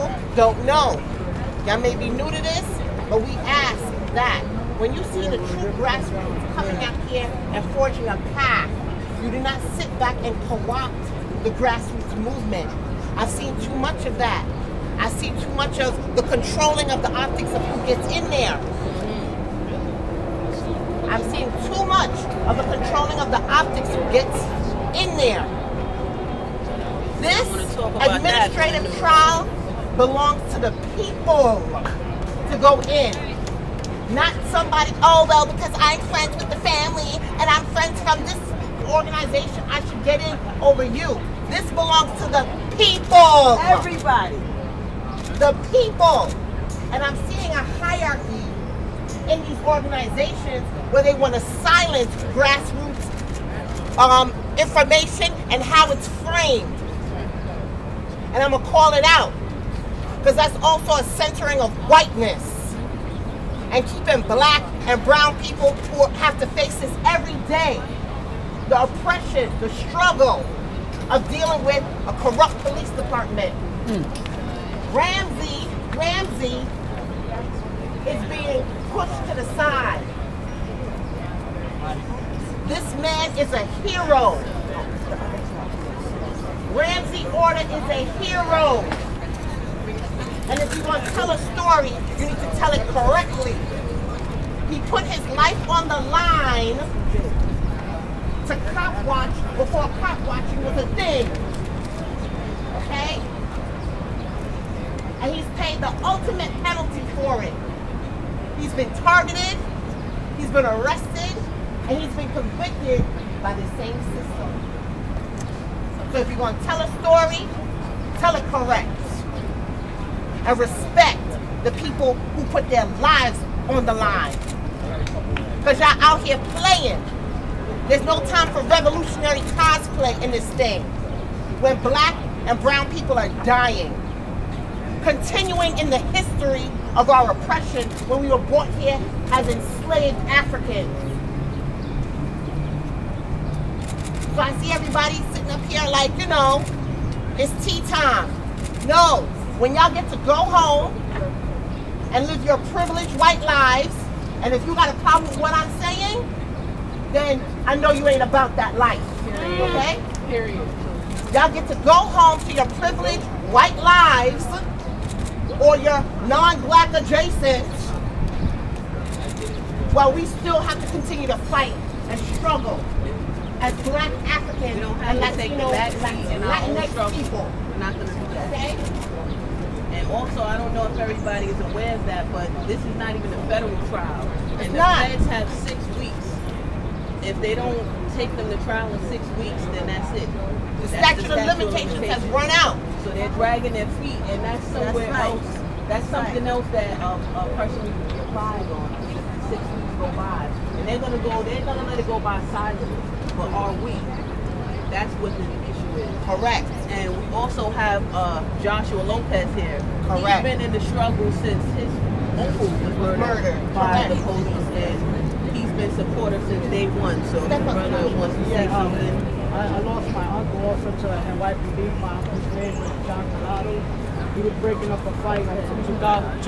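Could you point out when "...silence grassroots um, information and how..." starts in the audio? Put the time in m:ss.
0:51.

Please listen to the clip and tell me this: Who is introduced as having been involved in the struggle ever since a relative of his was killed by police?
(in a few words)
Joshua Lopez.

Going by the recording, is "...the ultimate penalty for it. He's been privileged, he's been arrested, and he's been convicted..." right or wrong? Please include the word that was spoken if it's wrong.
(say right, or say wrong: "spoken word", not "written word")
wrong: "targeted", not "privileged".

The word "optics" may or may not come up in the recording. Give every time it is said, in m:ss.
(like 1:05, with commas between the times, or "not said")
0:17, 0:23.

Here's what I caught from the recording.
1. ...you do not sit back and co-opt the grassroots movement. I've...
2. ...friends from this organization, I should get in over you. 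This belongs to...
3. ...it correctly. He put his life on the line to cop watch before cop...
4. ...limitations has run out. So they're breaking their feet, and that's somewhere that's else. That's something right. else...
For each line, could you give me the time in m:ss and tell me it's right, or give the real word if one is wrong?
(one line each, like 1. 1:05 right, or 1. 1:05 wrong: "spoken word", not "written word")
1. 0:09 right
2. 0:37 right
3. 1:32 right
4. 3:11 wrong: "dragging", not "breaking".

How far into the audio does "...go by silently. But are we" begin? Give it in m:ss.
3:22.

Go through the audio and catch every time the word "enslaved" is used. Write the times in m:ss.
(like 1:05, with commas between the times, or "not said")
2:19.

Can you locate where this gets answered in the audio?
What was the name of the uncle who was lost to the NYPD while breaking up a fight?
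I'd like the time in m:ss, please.
3:43.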